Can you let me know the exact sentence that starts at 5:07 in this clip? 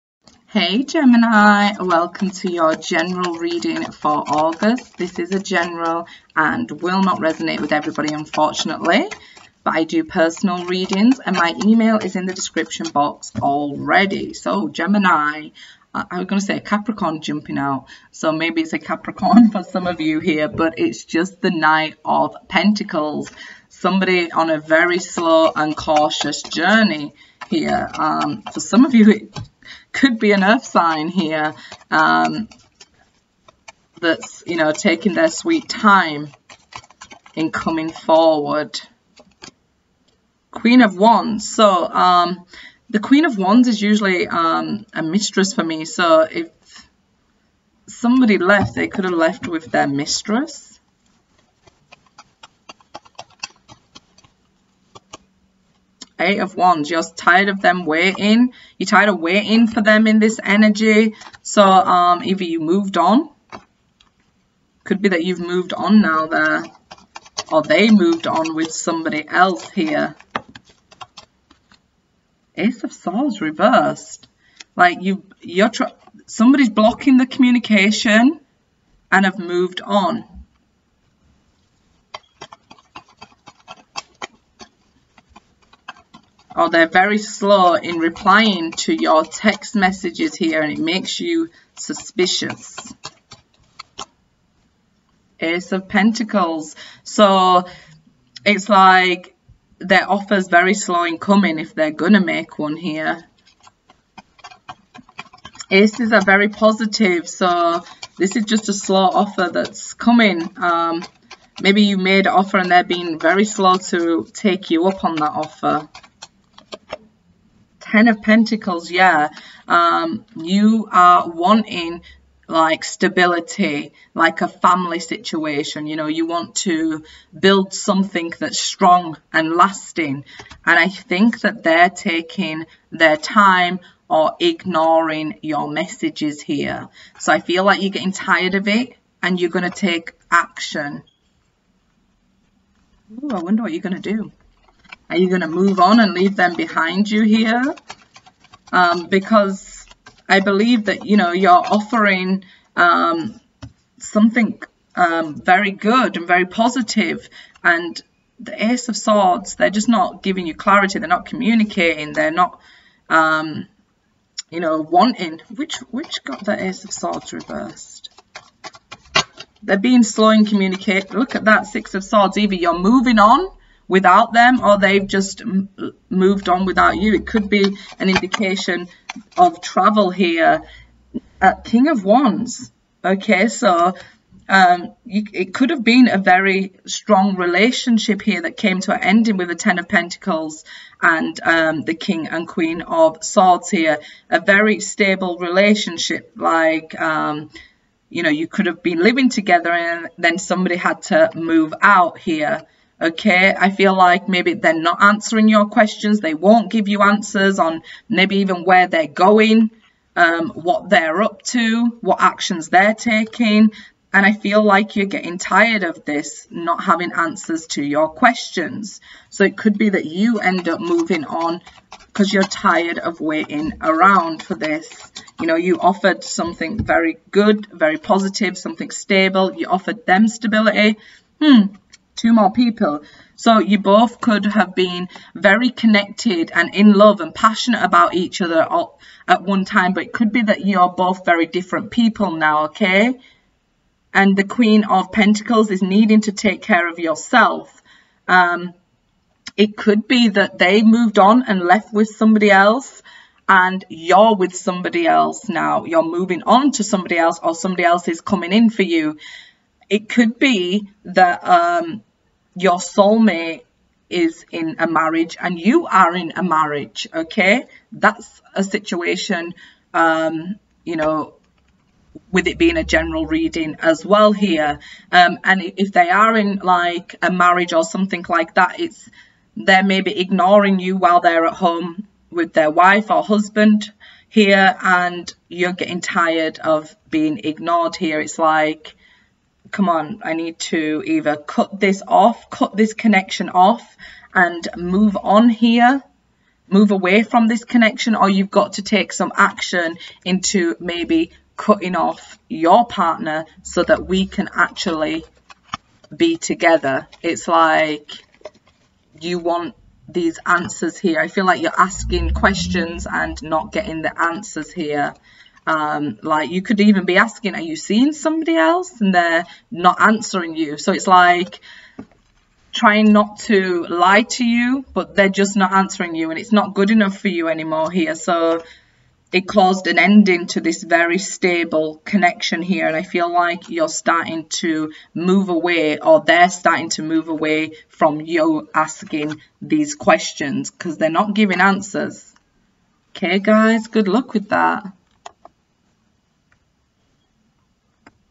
It's like you want these answers here.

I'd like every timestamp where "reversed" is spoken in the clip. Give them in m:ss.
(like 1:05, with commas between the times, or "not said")
1:13, 2:47.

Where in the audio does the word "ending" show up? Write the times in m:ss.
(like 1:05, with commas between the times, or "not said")
3:09, 5:29.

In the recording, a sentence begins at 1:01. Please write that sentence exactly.
So um, either you moved on.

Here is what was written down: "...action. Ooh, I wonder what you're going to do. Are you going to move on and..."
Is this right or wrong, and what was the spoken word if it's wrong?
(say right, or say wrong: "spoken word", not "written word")
right.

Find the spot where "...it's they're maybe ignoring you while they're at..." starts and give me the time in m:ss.
4:38.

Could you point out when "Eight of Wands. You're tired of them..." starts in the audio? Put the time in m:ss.
0:56.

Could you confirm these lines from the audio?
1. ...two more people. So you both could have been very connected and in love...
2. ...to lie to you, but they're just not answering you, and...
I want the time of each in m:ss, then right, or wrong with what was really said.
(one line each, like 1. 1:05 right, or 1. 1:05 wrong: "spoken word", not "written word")
1. 3:52 right
2. 5:23 right.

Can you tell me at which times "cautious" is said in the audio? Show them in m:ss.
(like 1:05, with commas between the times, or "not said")
0:25.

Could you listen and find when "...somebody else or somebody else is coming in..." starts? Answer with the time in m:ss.
4:16.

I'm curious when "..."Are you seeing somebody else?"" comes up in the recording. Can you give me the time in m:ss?
5:17.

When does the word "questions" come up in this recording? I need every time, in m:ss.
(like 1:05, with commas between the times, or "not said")
3:25, 3:38, 5:12, 5:39.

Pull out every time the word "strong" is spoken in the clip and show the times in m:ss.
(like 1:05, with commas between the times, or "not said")
2:08, 3:06.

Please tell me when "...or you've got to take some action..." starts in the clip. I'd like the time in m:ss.
4:58.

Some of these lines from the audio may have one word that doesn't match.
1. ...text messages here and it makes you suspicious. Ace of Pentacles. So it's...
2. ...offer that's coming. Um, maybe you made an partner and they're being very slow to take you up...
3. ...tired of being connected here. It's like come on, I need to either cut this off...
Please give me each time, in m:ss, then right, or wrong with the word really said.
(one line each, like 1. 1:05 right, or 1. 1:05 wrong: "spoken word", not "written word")
1. 1:29 right
2. 1:49 wrong: "offer", not "partner"
3. 4:46 wrong: "ignored", not "connected".